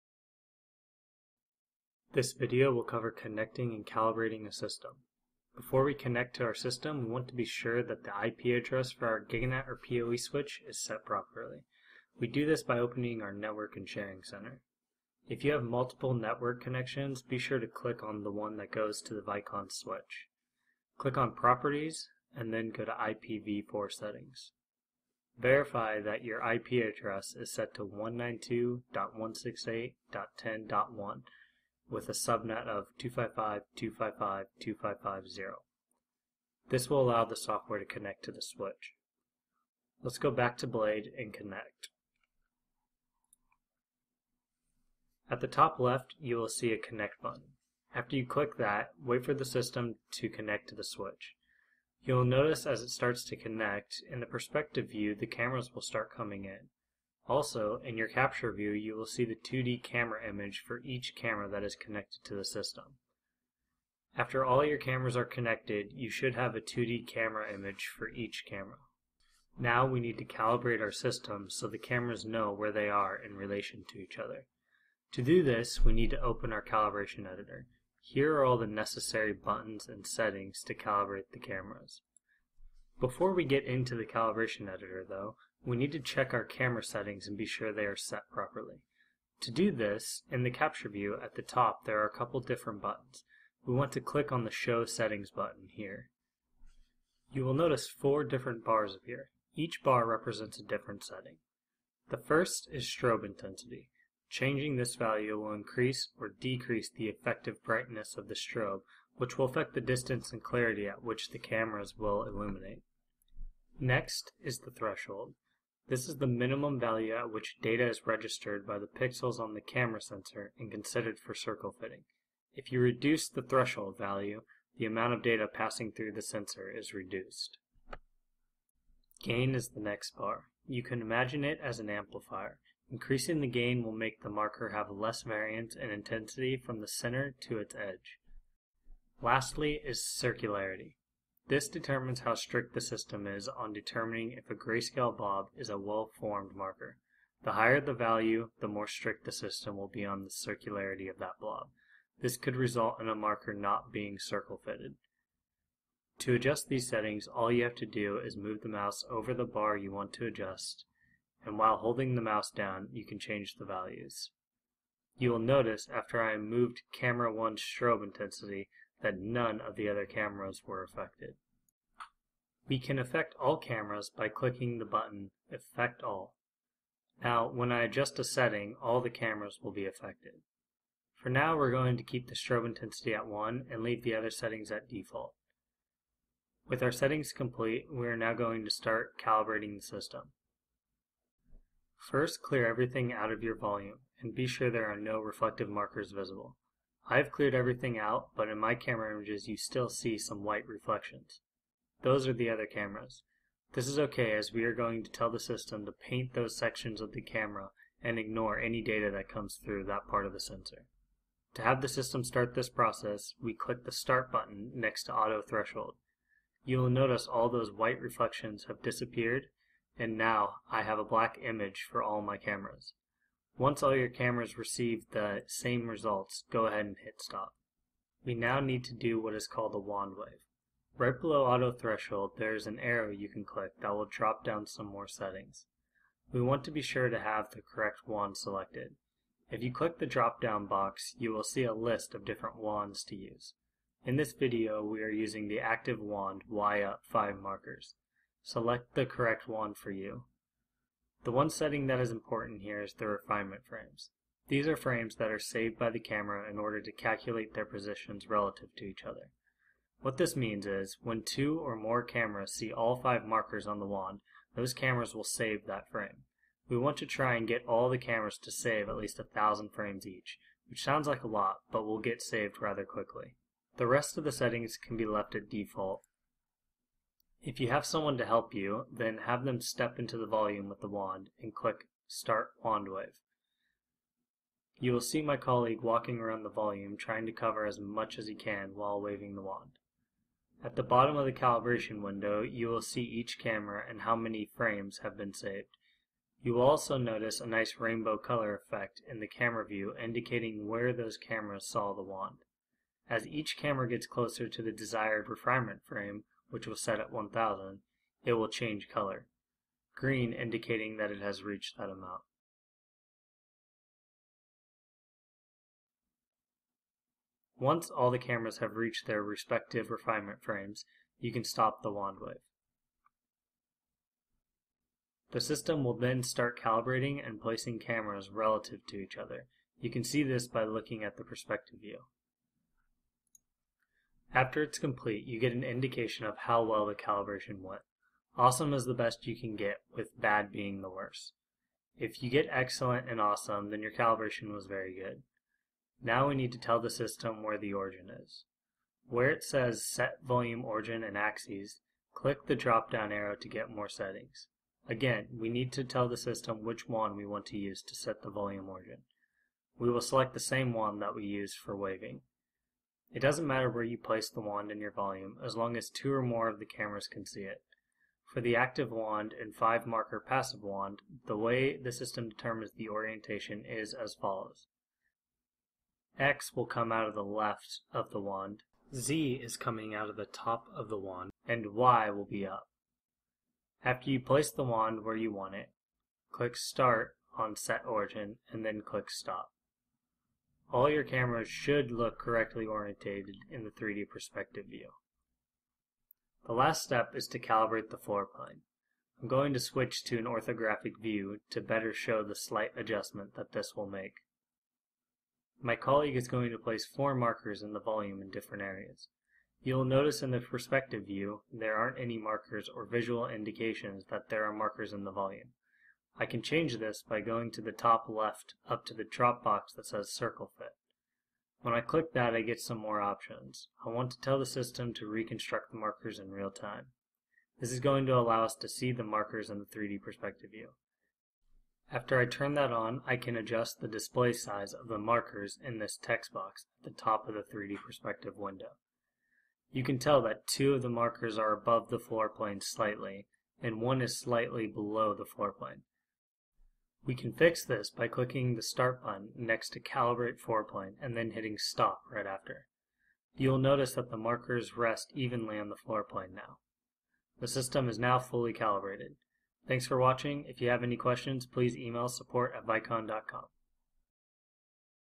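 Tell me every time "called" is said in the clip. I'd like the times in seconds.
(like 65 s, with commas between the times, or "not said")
229 s.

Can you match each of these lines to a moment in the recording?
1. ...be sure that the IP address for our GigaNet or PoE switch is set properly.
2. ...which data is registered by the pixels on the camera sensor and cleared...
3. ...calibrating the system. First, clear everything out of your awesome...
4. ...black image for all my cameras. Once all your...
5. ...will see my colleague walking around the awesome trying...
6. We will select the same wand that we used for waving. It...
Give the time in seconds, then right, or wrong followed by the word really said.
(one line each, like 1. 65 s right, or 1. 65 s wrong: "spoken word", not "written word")
1. 7 s right
2. 117 s wrong: "considered", not "cleared"
3. 189 s wrong: "volume", not "awesome"
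4. 221 s right
5. 284 s wrong: "volume", not "awesome"
6. 359 s right.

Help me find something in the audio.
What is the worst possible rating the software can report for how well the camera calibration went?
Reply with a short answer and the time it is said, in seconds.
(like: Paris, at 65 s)
bad, at 340 s.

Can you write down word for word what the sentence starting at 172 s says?
We can affect all cameras by clicking the button Affect All.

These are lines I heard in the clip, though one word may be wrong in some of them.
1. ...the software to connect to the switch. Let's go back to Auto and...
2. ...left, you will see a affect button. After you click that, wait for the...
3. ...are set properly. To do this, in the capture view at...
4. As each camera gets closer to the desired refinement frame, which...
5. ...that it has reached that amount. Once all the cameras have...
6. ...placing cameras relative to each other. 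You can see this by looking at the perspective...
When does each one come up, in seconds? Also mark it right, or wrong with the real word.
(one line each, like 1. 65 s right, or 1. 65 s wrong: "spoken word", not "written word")
1. 37 s wrong: "Blade", not "Auto"
2. 45 s wrong: "connect", not "affect"
3. 87 s right
4. 303 s right
5. 310 s right
6. 327 s right.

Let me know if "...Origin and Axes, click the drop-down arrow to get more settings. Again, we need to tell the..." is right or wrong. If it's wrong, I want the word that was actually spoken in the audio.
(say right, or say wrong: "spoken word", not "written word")
right.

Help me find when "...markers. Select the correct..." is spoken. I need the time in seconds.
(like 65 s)
247 s.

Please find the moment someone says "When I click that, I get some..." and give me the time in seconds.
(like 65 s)
421 s.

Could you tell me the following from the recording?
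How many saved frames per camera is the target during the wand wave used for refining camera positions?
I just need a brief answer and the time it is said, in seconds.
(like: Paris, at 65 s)
1000, at 269 s.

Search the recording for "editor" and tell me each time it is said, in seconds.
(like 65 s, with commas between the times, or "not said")
77 s, 84 s.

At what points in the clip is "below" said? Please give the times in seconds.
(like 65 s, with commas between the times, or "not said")
231 s, 444 s.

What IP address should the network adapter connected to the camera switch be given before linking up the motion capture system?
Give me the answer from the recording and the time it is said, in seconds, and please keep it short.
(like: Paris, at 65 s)
192.168.10.1, at 27 s.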